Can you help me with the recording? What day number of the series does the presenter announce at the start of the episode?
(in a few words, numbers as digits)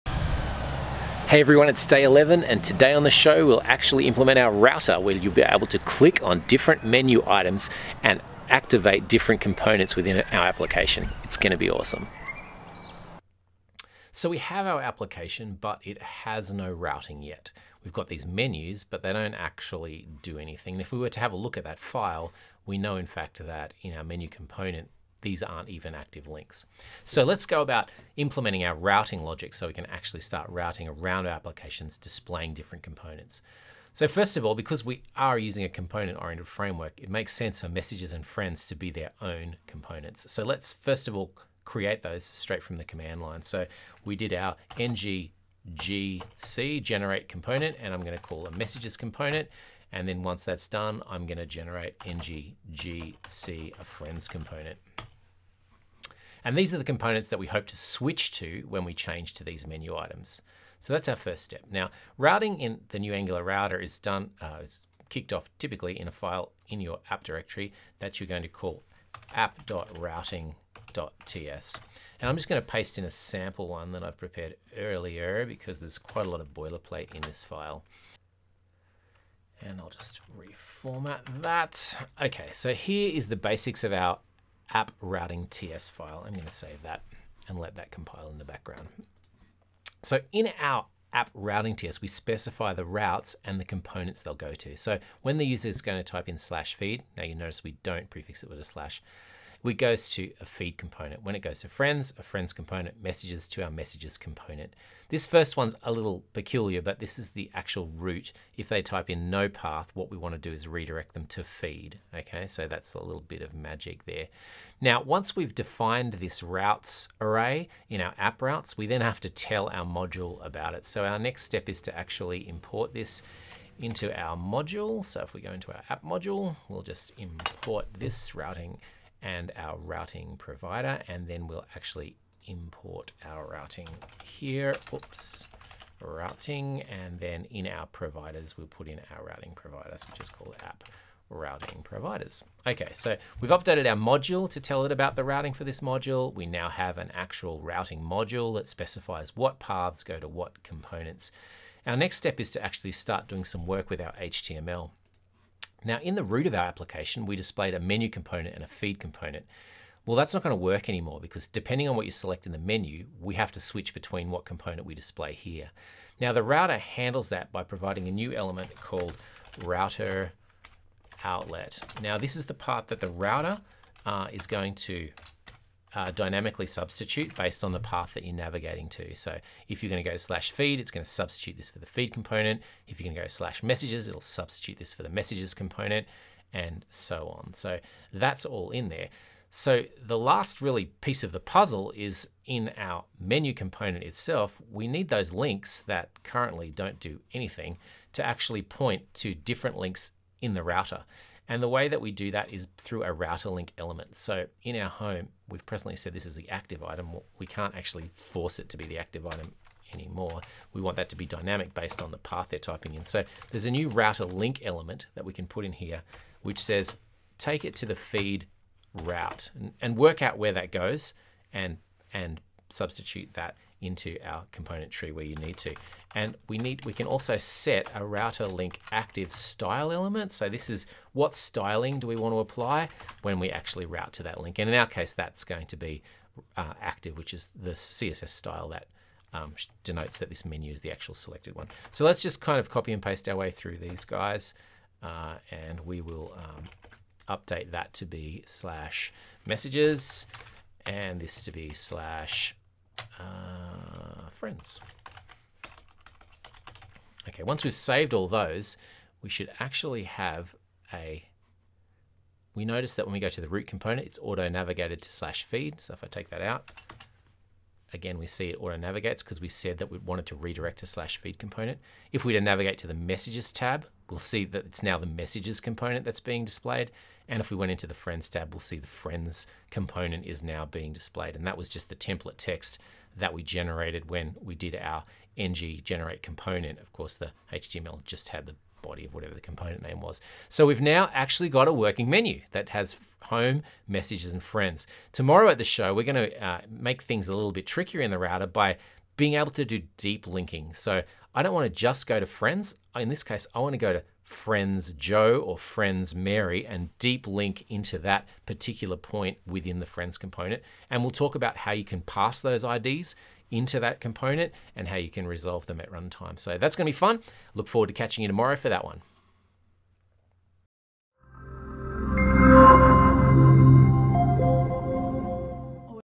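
11.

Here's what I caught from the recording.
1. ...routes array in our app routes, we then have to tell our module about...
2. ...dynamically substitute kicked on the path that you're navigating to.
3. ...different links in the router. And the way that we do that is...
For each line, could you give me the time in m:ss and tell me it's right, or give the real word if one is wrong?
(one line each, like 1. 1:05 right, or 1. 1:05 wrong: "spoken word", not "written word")
1. 1:56 right
2. 2:56 wrong: "based", not "kicked"
3. 3:19 right.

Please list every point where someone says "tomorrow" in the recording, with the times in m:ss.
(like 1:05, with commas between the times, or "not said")
4:55, 5:18.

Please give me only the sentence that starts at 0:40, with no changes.
So let's first of all create those straight from the command line.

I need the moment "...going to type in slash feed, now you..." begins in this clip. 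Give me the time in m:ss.
1:35.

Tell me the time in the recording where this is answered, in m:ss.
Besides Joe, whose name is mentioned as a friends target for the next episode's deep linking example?
5:06.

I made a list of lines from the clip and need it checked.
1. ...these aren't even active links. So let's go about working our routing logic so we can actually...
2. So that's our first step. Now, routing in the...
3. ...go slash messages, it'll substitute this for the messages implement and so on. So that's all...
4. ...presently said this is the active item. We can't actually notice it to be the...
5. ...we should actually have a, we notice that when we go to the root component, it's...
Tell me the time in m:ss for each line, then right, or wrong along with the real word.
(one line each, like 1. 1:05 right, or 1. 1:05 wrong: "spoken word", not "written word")
1. 0:25 wrong: "implementing", not "working"
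2. 1:00 right
3. 3:03 wrong: "component", not "implement"
4. 3:25 wrong: "force", not "notice"
5. 4:19 right.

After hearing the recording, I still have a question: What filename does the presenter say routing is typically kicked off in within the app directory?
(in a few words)
app.routing.ts.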